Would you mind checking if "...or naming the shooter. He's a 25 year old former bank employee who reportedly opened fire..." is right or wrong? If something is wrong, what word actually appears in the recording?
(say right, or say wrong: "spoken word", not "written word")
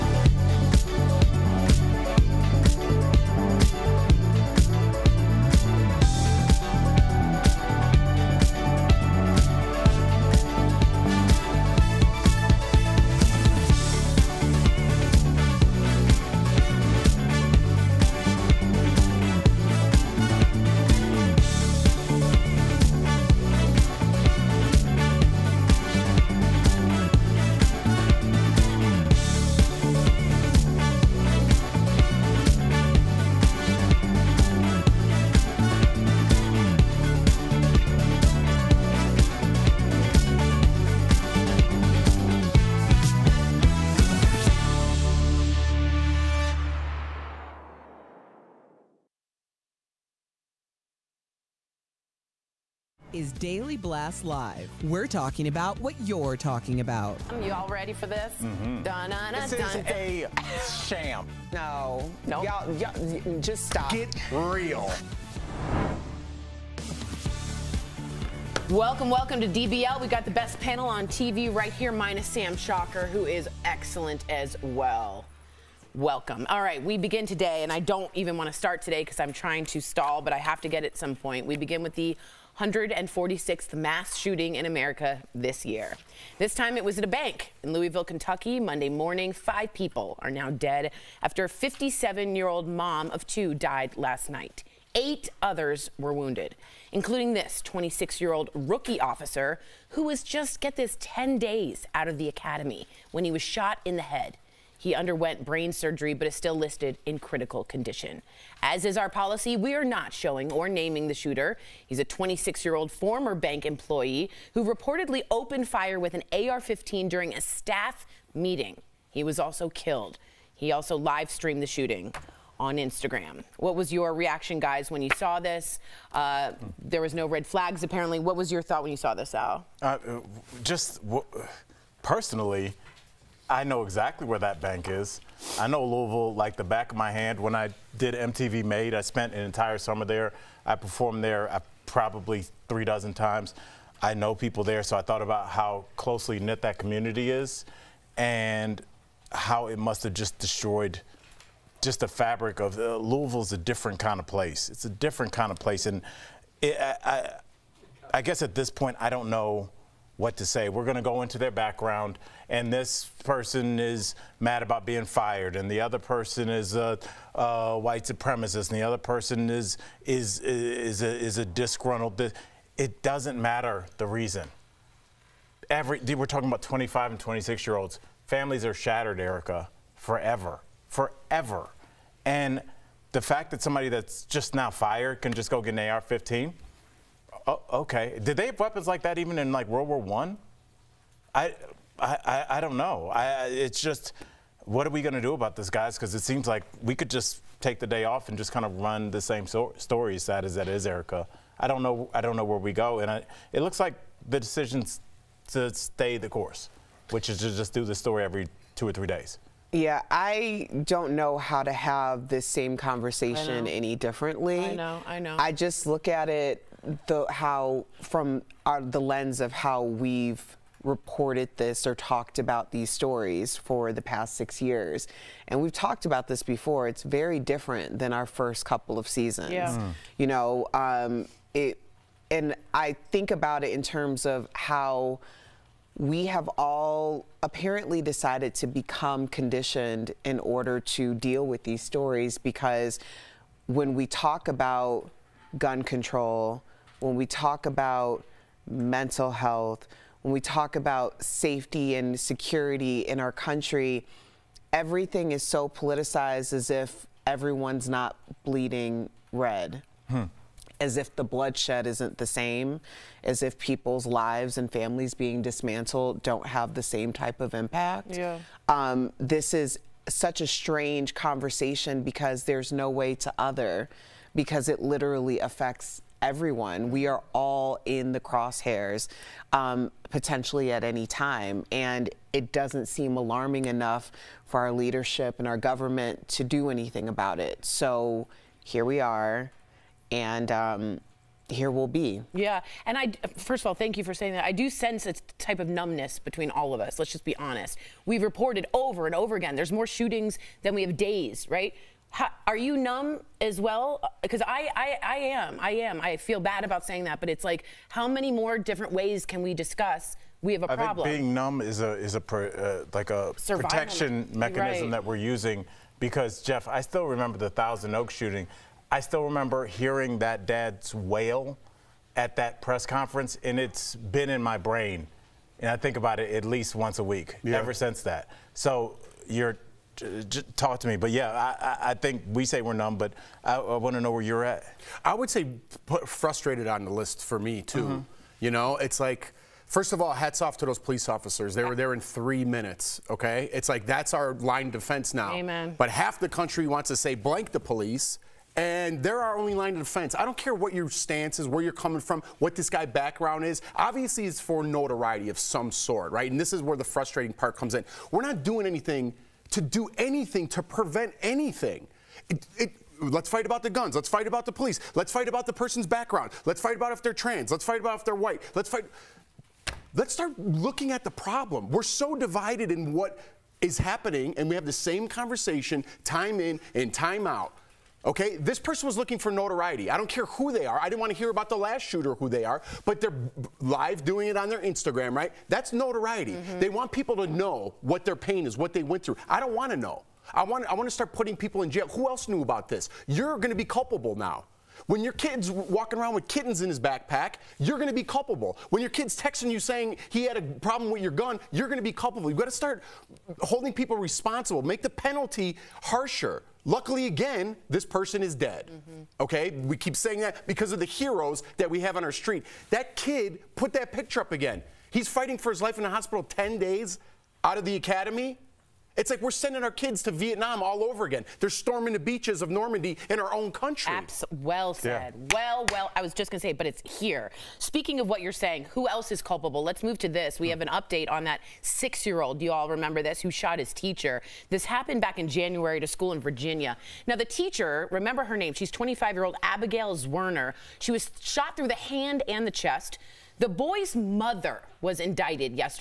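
wrong: "26", not "25".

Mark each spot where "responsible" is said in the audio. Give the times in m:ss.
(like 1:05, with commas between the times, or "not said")
6:44.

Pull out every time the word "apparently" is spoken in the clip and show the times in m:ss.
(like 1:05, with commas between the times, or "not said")
2:07, 3:57.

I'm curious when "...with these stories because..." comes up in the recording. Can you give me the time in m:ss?
4:01.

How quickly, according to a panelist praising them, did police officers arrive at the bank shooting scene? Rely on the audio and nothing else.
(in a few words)
3 minutes.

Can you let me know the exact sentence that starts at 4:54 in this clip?
I do sense a type of numbness between all of us.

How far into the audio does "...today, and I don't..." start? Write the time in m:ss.
1:17.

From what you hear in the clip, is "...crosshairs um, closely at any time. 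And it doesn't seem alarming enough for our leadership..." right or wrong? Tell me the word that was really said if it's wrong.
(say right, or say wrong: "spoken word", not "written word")
wrong: "potentially", not "closely".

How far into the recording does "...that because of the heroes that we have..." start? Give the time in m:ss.
6:50.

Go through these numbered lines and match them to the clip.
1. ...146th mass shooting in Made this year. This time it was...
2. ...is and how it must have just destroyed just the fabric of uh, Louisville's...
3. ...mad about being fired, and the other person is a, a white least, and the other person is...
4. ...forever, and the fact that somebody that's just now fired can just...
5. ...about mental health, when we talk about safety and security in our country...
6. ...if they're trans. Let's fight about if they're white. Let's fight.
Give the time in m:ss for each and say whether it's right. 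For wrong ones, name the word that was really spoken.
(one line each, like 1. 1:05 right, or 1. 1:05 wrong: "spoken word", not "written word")
1. 1:22 wrong: "America", not "Made"
2. 2:27 right
3. 2:44 wrong: "supremacist", not "least"
4. 3:00 right
5. 4:07 right
6. 6:06 right.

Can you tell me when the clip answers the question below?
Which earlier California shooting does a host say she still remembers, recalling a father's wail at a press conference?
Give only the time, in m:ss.
5:17.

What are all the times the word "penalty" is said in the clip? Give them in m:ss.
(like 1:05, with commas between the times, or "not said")
6:45.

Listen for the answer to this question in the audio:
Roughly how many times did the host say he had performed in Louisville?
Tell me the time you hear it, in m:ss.
2:22.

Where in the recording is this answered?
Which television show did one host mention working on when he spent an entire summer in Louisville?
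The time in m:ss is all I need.
2:18.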